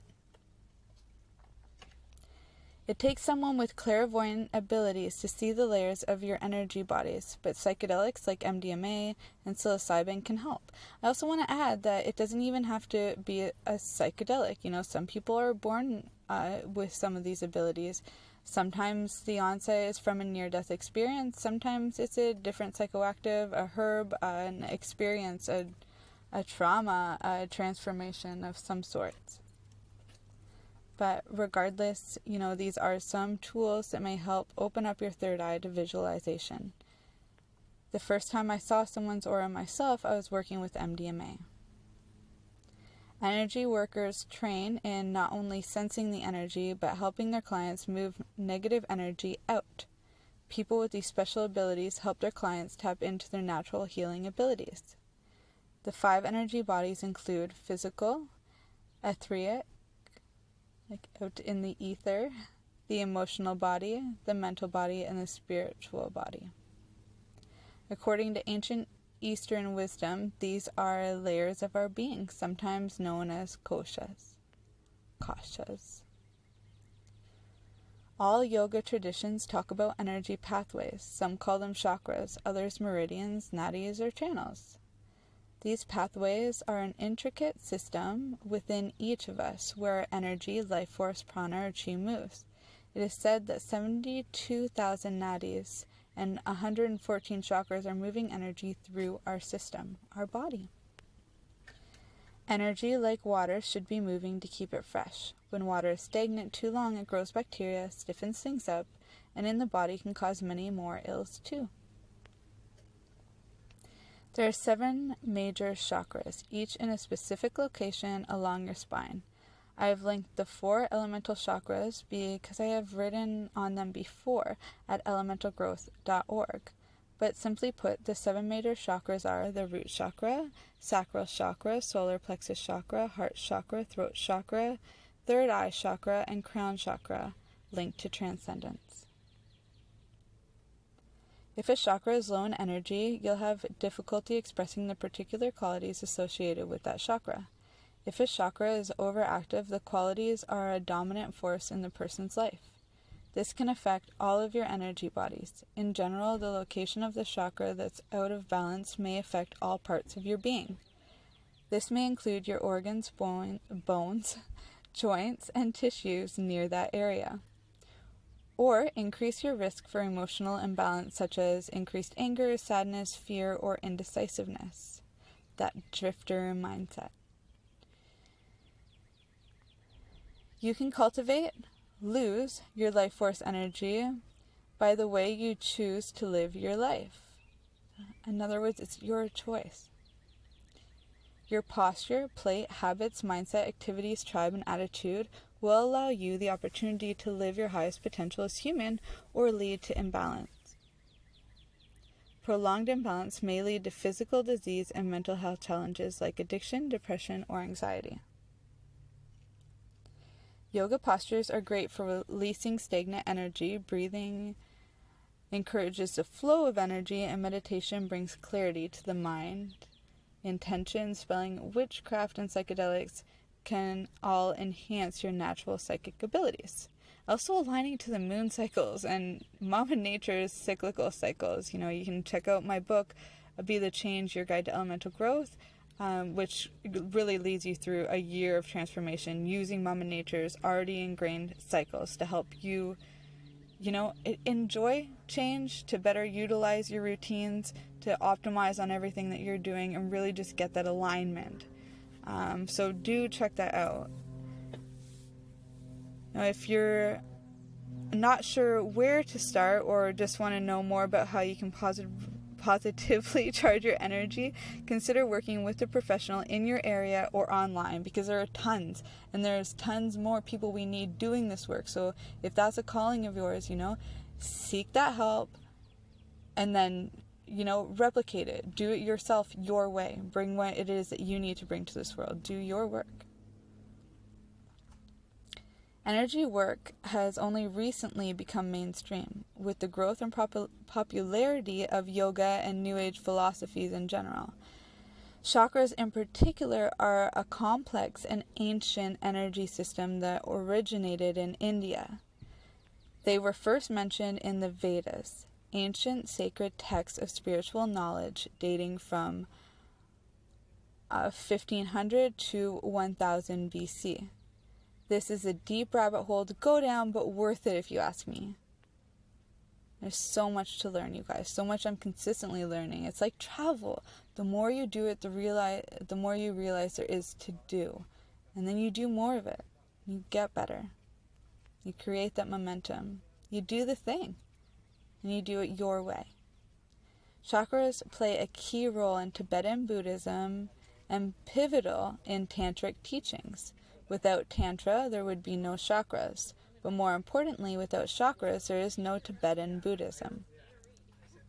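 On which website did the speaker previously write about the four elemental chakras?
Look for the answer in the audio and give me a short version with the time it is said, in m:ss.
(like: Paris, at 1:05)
elementalgrowth.org, at 2:05.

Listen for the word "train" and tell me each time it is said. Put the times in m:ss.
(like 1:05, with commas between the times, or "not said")
0:44.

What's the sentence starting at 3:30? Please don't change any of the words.
Yoga postures are great for releasing stagnant energy, breathing encourages the flow of energy, and meditation brings clarity to the mind.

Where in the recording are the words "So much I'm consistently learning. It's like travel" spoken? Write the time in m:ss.
5:21.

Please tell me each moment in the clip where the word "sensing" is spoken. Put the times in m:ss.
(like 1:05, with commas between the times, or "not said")
0:45.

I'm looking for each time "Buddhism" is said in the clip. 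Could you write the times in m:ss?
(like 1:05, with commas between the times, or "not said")
5:39, 5:49.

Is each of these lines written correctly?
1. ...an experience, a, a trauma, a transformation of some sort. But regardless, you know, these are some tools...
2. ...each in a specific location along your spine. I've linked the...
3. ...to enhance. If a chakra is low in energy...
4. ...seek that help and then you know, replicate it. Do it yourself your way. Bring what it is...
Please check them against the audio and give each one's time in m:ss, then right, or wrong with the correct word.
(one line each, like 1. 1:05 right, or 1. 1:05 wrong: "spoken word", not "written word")
1. 0:24 right
2. 1:56 right
3. 2:17 wrong: "transcendence", not "enhance"
4. 4:34 right.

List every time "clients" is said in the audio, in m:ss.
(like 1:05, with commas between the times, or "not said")
0:47, 0:52.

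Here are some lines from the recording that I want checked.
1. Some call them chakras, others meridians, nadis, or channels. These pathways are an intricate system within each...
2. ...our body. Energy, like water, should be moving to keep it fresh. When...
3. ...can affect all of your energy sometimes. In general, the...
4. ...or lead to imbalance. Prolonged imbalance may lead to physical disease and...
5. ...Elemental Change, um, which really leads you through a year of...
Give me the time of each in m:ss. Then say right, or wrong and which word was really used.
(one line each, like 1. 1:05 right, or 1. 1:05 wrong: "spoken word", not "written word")
1. 1:21 right
2. 1:40 right
3. 2:33 wrong: "bodies", not "sometimes"
4. 3:19 right
5. 3:54 wrong: "Growth", not "Change".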